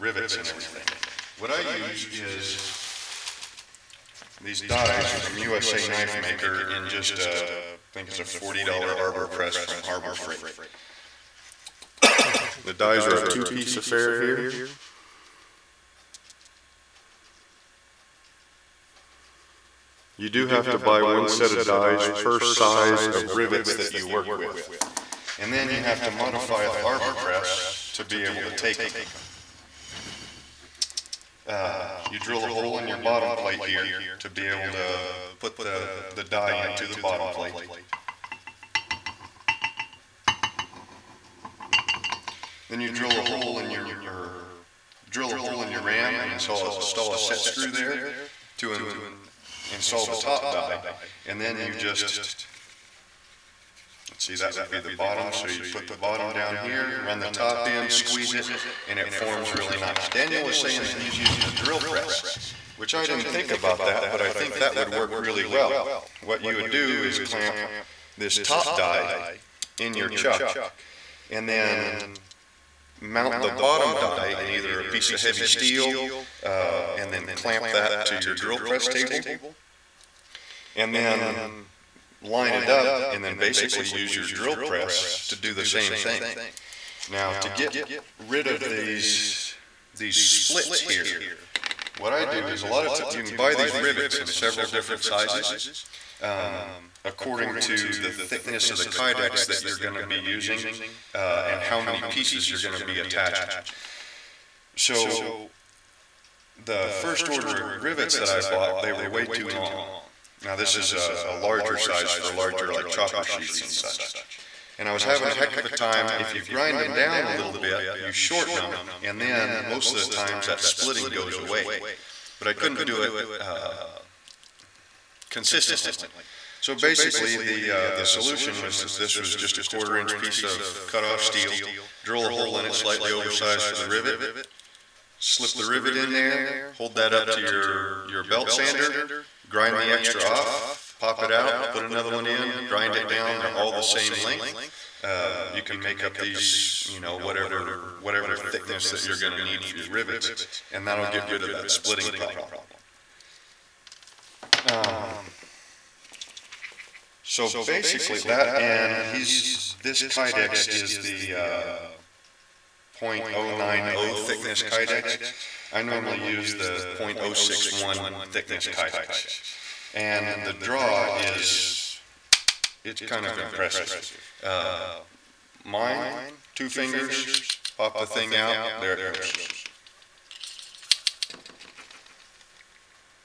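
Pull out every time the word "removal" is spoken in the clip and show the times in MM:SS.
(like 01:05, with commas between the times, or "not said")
not said.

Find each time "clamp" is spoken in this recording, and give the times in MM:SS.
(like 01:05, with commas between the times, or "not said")
01:07, 01:17.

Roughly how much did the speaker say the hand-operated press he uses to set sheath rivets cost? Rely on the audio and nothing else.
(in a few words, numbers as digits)
$40.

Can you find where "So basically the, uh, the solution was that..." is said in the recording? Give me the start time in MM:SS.
02:06.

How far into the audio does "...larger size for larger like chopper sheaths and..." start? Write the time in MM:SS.
01:51.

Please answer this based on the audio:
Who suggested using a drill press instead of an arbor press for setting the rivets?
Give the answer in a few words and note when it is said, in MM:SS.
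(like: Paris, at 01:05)
Daniel, at 01:00.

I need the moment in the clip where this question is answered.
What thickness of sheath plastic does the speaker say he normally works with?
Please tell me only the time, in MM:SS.
02:46.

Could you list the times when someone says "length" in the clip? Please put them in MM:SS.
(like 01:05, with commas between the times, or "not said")
02:24.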